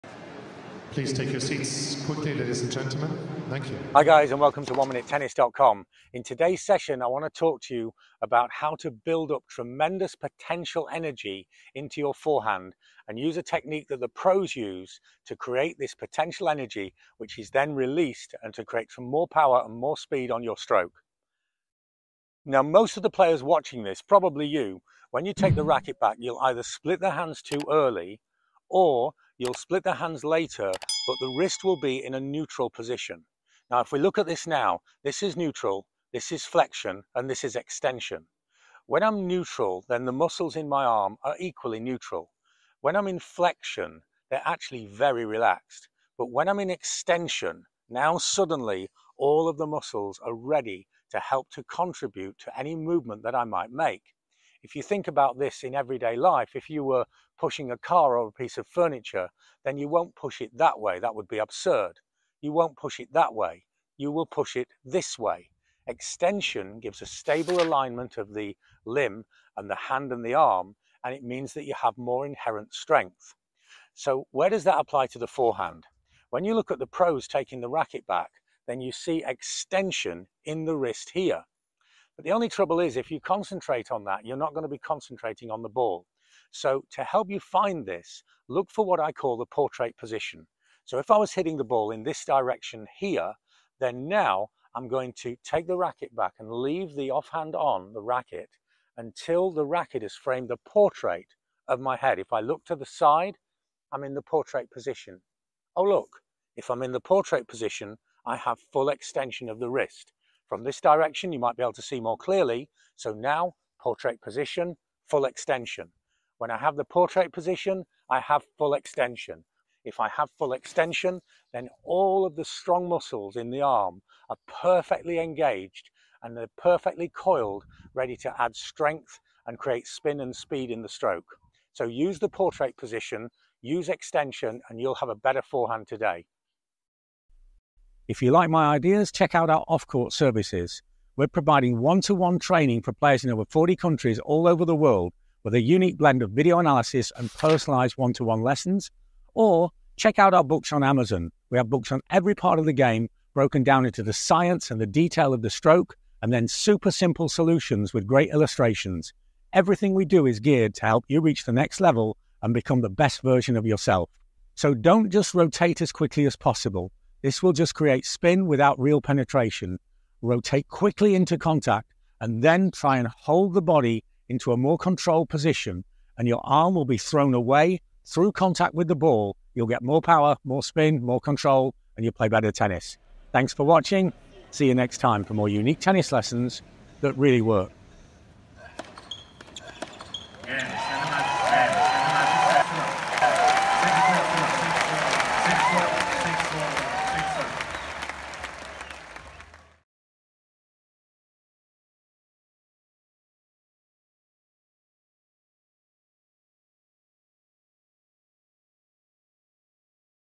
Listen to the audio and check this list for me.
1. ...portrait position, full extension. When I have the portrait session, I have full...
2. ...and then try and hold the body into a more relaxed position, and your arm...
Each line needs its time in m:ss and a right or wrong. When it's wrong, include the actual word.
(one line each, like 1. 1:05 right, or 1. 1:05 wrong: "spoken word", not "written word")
1. 1:53 wrong: "position", not "session"
2. 2:52 wrong: "controlled", not "relaxed".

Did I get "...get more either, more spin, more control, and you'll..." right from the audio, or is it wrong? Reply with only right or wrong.
wrong.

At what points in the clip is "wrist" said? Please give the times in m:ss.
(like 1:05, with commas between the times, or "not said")
0:31, 1:20, 1:49.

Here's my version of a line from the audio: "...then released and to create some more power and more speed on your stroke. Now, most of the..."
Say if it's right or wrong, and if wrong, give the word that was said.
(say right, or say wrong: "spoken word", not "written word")
right.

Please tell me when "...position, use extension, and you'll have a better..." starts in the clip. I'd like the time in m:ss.
2:12.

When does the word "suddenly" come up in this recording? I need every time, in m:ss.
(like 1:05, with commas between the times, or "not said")
0:48.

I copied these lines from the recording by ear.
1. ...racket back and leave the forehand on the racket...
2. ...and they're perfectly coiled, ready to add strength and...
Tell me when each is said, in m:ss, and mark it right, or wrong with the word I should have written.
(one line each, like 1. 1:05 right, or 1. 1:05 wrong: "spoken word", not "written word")
1. 1:35 wrong: "offhand", not "forehand"
2. 2:06 right.